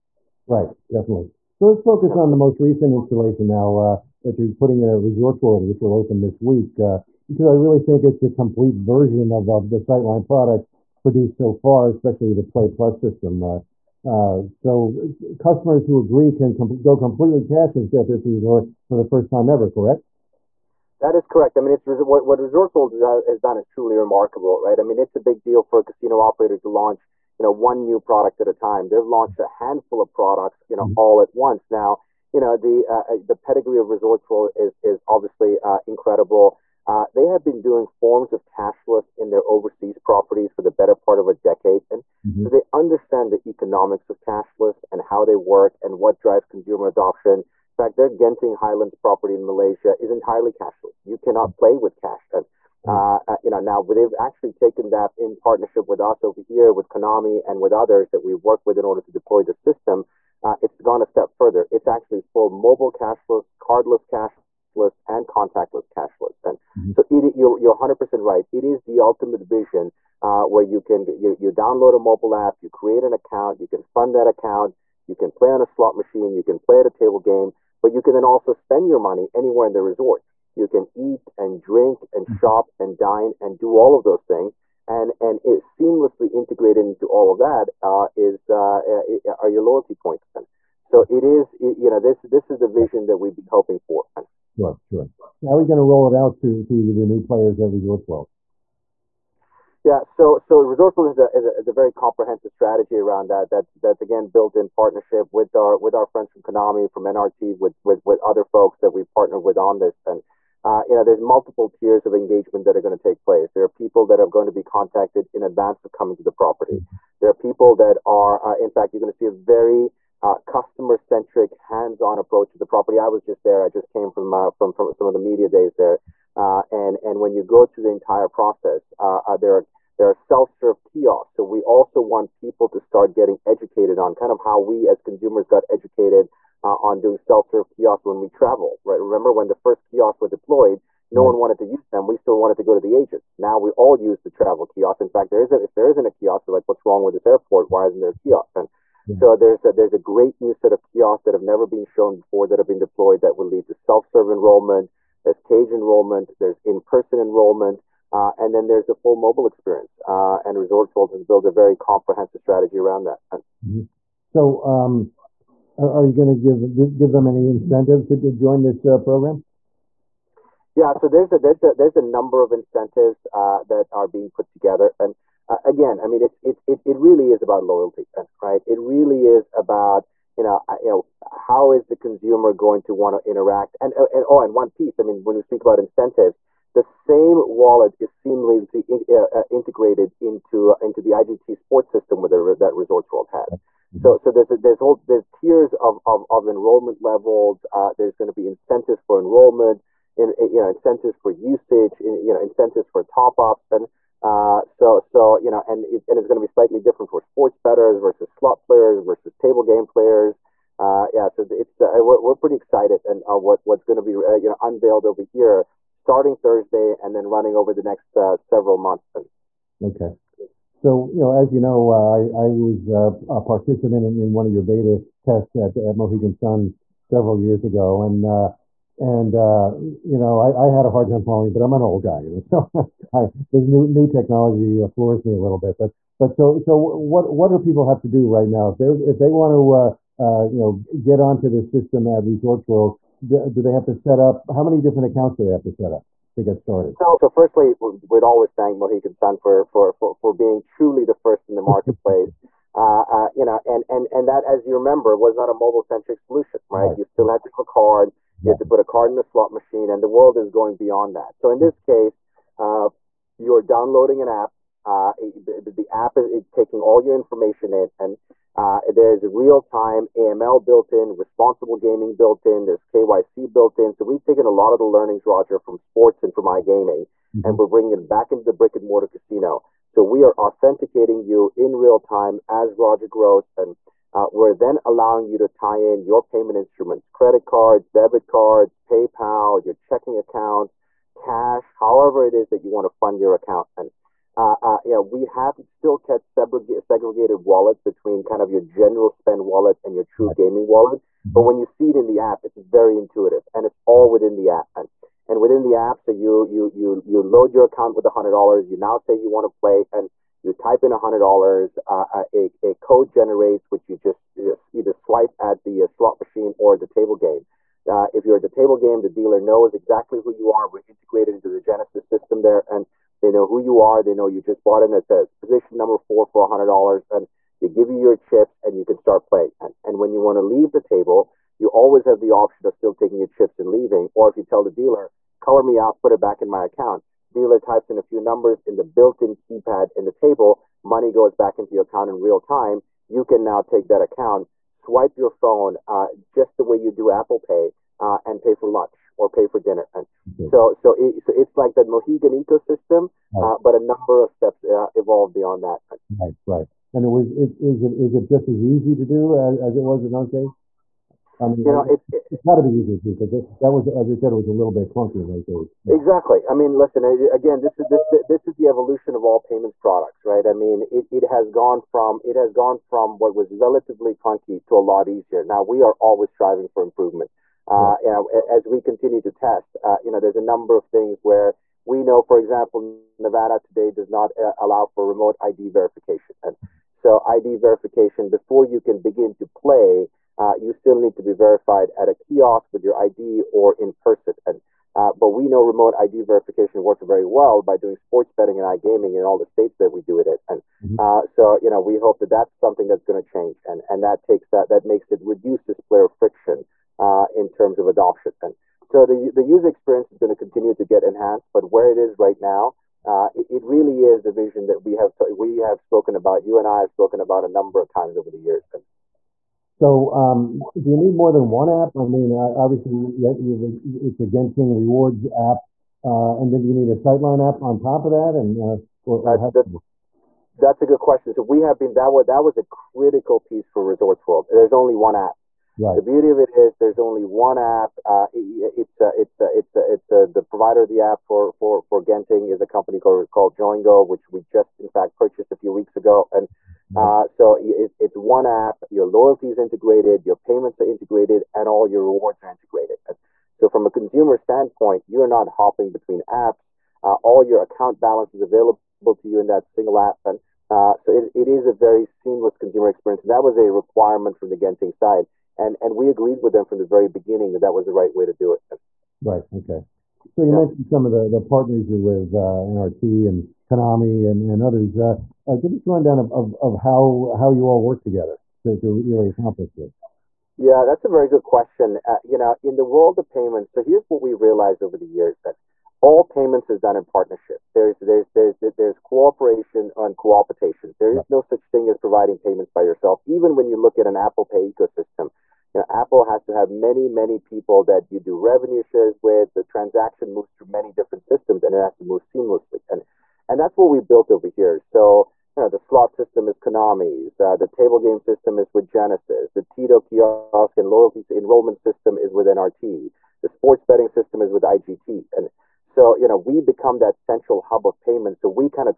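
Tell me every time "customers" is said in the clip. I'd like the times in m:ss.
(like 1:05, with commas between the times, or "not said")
0:15, 2:00.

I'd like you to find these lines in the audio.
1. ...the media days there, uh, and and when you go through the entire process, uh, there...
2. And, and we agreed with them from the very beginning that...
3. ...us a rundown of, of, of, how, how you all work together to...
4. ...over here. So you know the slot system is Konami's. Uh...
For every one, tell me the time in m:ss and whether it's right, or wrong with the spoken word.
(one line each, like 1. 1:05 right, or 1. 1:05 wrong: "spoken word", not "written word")
1. 2:05 right
2. 7:45 right
3. 7:55 right
4. 8:24 right.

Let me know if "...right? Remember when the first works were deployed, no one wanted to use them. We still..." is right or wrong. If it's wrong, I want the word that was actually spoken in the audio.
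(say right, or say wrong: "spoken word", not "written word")
wrong: "kiosks", not "works".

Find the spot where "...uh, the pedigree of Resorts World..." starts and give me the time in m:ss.
0:33.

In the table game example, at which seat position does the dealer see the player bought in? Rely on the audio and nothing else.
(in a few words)
4.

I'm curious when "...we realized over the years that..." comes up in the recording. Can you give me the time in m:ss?
8:04.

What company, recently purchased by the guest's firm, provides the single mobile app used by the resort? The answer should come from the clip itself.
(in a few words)
Joingo.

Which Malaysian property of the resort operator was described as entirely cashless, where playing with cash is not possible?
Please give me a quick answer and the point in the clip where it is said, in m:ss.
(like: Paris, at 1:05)
Genting Highlands, at 0:48.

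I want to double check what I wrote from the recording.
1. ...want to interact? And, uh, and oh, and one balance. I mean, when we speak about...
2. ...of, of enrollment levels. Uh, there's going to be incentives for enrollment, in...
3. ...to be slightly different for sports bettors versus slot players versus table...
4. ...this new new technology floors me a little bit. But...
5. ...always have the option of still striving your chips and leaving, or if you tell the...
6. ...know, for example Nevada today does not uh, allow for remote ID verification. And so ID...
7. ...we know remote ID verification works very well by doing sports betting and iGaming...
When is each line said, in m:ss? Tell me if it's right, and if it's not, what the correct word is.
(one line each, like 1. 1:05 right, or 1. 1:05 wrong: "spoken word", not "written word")
1. 3:02 wrong: "piece", not "balance"
2. 3:16 right
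3. 3:26 right
4. 3:53 right
5. 5:31 wrong: "taking", not "striving"
6. 6:22 right
7. 6:35 right.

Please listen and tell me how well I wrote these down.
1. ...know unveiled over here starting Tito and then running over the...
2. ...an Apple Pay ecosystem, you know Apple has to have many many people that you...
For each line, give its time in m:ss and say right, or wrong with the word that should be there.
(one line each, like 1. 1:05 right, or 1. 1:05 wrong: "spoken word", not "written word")
1. 3:34 wrong: "Thursday", not "Tito"
2. 8:14 right.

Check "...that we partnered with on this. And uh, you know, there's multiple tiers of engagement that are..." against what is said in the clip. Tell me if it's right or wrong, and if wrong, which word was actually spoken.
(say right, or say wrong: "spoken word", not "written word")
right.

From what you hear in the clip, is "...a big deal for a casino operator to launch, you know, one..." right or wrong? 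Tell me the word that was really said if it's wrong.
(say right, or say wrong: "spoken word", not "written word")
right.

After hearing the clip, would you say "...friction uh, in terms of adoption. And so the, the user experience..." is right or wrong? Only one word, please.
right.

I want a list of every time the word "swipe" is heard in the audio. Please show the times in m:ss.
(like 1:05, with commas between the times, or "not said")
5:14, 5:44.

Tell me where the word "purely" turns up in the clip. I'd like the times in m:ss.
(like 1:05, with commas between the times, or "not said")
not said.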